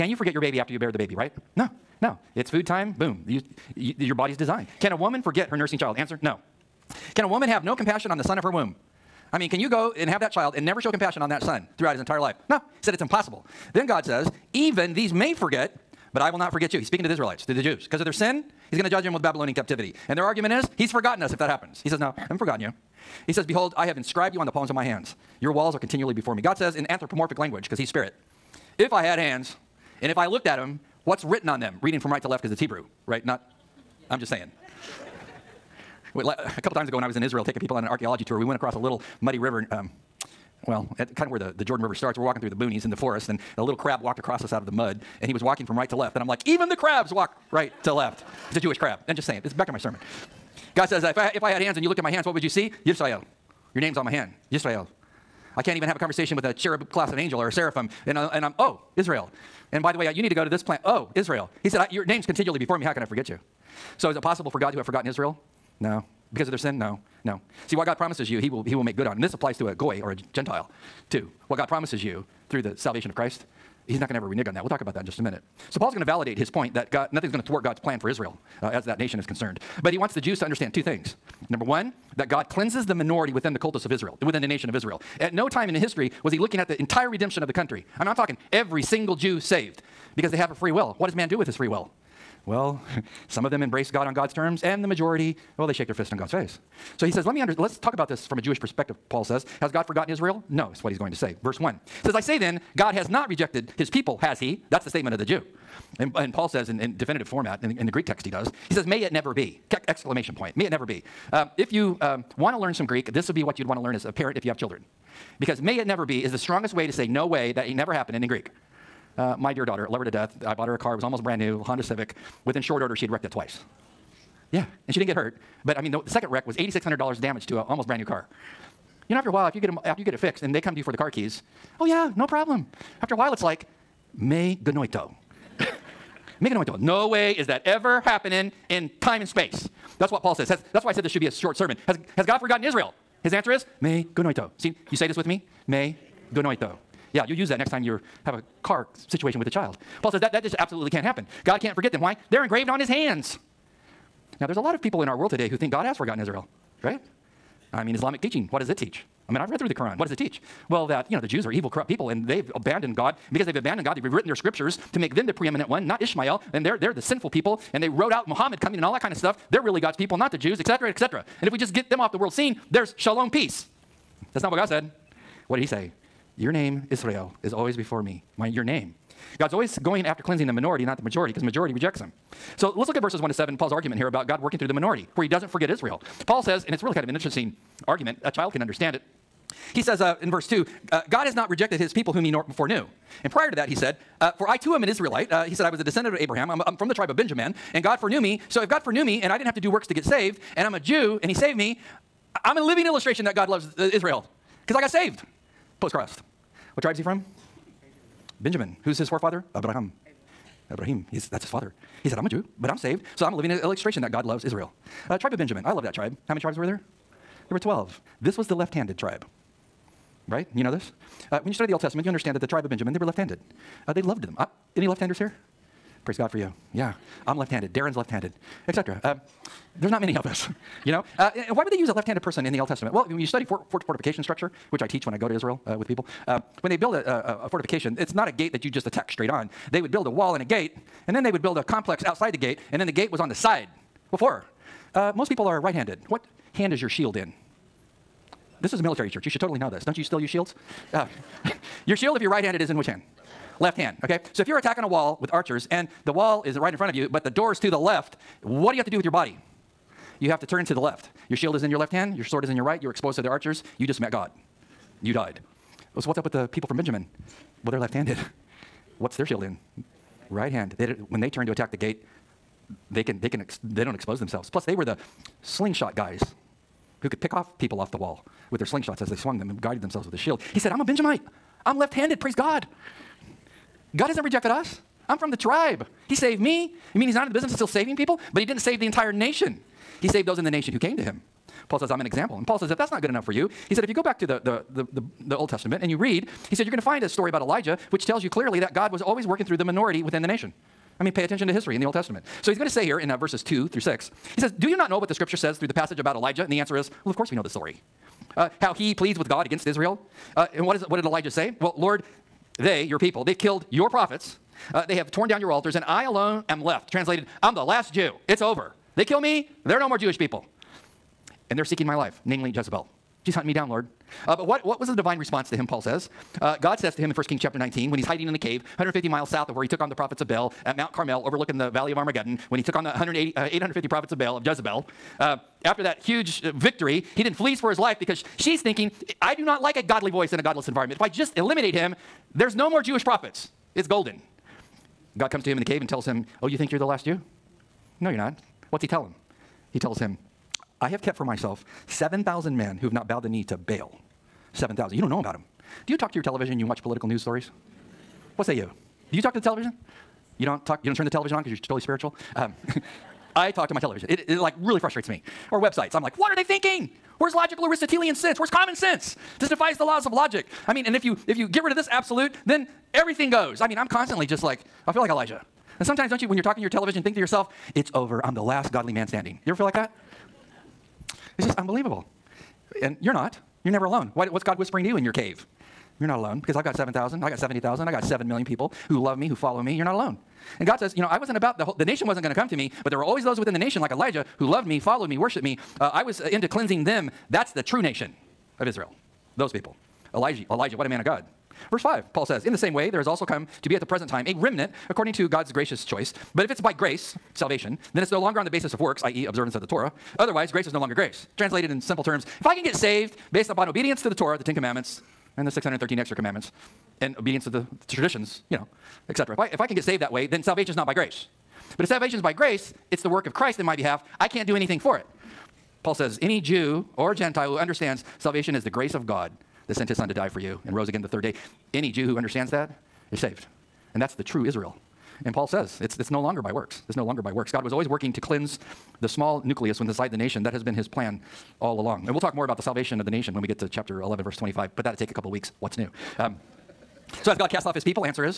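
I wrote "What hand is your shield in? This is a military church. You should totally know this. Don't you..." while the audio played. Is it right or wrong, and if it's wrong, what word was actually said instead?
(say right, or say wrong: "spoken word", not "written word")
right.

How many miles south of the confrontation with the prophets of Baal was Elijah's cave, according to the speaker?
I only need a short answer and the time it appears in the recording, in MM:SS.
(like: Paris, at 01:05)
150 miles, at 05:28.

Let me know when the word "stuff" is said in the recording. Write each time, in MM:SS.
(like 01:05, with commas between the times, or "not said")
02:49.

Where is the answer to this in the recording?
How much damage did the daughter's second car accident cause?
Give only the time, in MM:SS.
02:06.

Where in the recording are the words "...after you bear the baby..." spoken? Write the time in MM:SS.
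00:00.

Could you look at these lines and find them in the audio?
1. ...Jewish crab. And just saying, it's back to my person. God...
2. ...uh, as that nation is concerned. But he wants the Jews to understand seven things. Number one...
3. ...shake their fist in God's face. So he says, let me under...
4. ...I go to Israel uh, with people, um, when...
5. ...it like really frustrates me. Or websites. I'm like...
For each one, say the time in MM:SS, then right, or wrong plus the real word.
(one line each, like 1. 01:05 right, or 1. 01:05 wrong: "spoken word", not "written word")
1. 00:48 wrong: "sermon", not "person"
2. 01:18 wrong: "two", not "seven"
3. 01:35 right
4. 03:55 right
5. 06:04 right.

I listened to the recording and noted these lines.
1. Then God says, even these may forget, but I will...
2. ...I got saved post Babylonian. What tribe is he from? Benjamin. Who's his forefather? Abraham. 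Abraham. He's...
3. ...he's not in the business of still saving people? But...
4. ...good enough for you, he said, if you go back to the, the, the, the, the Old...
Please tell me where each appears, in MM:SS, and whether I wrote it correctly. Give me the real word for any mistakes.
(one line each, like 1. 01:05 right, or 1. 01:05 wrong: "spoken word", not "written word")
1. 00:13 right
2. 03:24 wrong: "Christ", not "Babylonian"
3. 04:47 right
4. 04:53 right.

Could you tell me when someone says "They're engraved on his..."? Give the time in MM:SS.
02:32.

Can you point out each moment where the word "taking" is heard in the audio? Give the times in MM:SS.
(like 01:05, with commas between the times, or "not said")
00:37.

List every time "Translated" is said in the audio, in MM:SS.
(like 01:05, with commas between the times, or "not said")
05:16, 06:51.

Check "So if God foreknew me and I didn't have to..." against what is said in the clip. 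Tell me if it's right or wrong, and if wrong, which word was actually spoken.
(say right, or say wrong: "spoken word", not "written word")
right.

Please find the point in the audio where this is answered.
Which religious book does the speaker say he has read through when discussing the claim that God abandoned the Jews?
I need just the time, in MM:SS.
02:39.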